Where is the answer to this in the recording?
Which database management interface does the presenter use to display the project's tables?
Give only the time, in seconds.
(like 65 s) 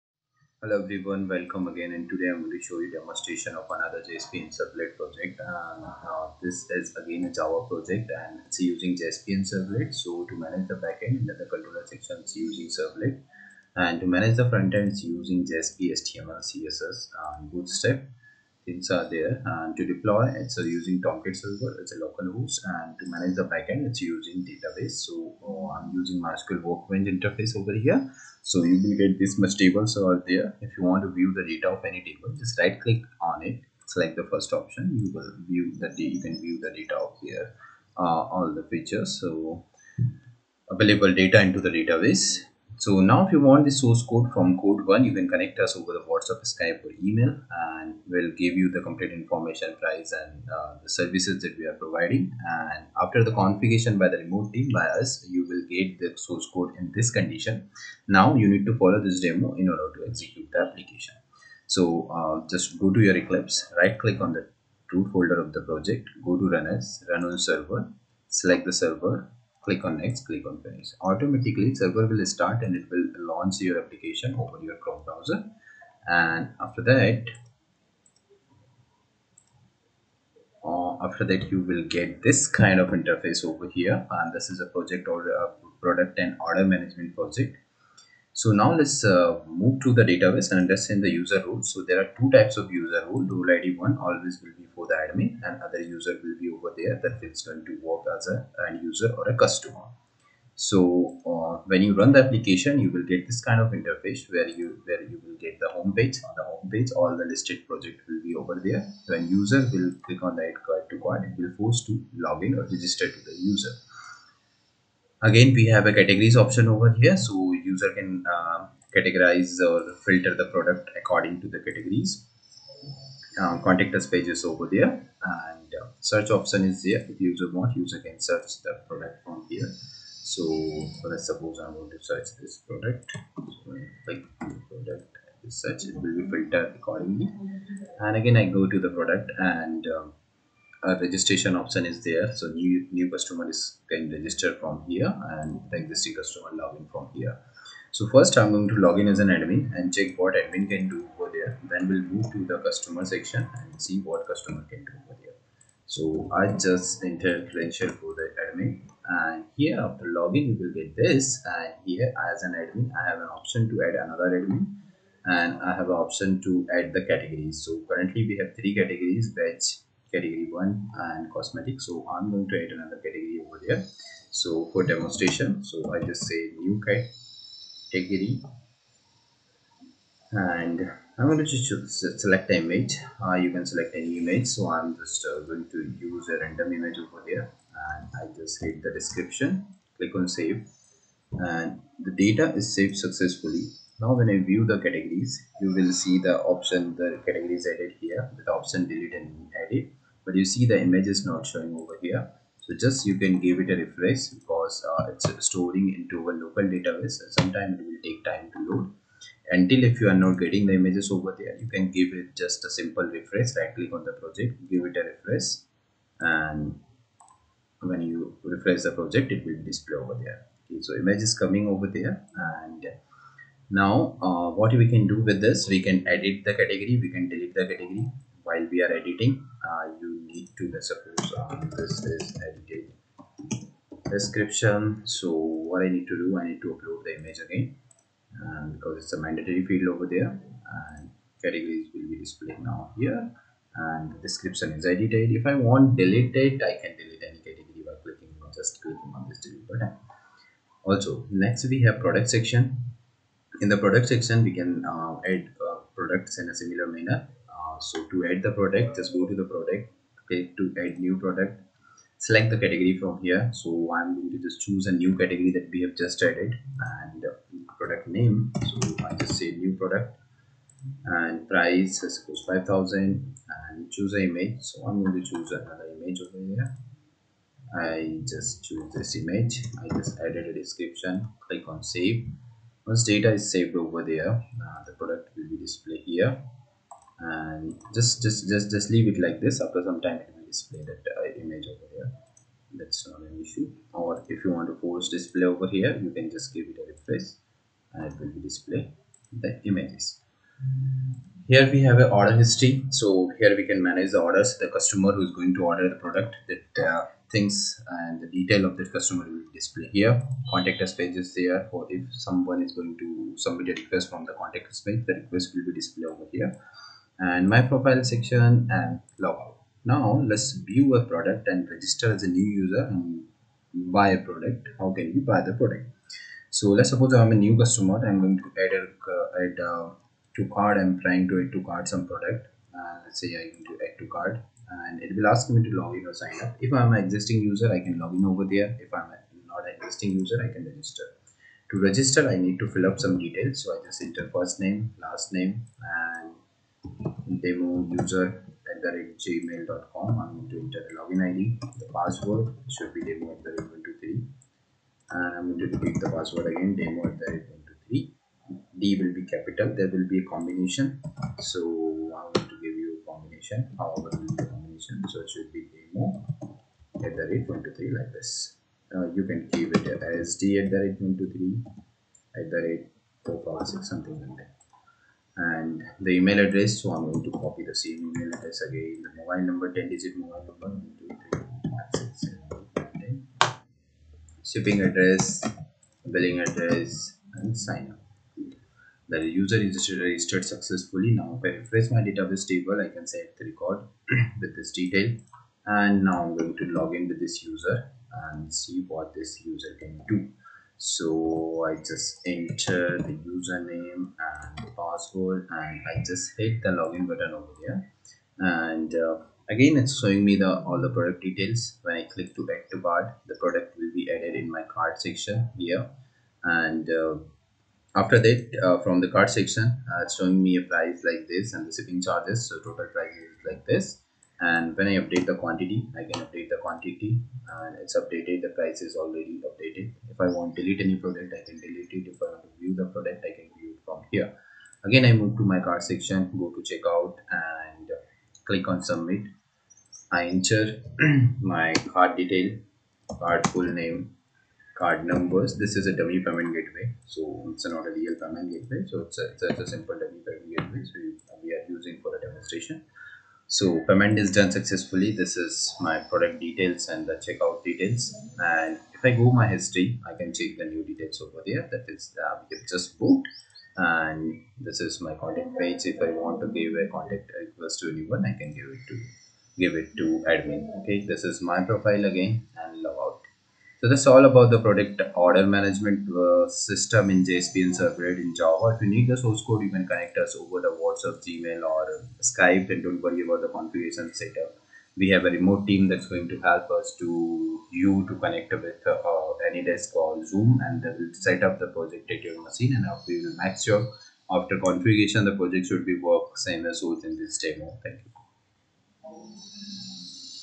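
26 s.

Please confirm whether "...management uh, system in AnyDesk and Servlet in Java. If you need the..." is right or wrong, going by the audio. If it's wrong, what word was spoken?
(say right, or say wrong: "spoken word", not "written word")
wrong: "JSP", not "AnyDesk".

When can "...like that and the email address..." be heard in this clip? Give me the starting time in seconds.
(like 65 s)
374 s.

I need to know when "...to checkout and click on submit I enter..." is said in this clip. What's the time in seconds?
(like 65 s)
436 s.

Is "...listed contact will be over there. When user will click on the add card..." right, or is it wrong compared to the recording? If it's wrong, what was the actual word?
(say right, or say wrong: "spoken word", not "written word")
wrong: "project", not "contact".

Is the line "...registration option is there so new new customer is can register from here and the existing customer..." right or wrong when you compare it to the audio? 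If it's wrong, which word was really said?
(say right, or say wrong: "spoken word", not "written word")
right.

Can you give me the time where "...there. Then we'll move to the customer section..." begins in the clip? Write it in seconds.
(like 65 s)
151 s.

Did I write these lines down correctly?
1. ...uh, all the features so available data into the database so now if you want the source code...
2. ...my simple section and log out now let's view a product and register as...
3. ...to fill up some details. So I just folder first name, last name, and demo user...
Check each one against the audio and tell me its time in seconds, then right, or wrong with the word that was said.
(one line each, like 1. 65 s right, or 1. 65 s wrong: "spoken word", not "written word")
1. 37 s right
2. 317 s wrong: "profile", not "simple"
3. 342 s wrong: "enter", not "folder".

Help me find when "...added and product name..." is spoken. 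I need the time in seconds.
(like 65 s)
266 s.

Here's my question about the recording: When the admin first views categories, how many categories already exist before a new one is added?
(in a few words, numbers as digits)
3.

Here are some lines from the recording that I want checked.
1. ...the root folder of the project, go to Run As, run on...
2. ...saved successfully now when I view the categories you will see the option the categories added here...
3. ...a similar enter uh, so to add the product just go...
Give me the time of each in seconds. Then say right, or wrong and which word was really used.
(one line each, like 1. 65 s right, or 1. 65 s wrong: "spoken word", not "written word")
1. 64 s right
2. 192 s right
3. 256 s wrong: "manner", not "enter".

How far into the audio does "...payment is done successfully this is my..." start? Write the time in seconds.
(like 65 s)
453 s.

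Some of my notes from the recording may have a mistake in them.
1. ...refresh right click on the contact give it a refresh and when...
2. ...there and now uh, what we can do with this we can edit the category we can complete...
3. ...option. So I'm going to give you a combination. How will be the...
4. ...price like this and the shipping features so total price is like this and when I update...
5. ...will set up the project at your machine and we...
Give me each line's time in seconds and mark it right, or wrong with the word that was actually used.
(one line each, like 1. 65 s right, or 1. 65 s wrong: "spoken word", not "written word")
1. 213 s wrong: "project", not "contact"
2. 221 s wrong: "delete", not "complete"
3. 360 s wrong: "combination", not "option"
4. 420 s wrong: "charges", not "features"
5. 490 s right.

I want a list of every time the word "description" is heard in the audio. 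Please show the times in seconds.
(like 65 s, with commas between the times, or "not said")
188 s, 234 s, 244 s, 280 s.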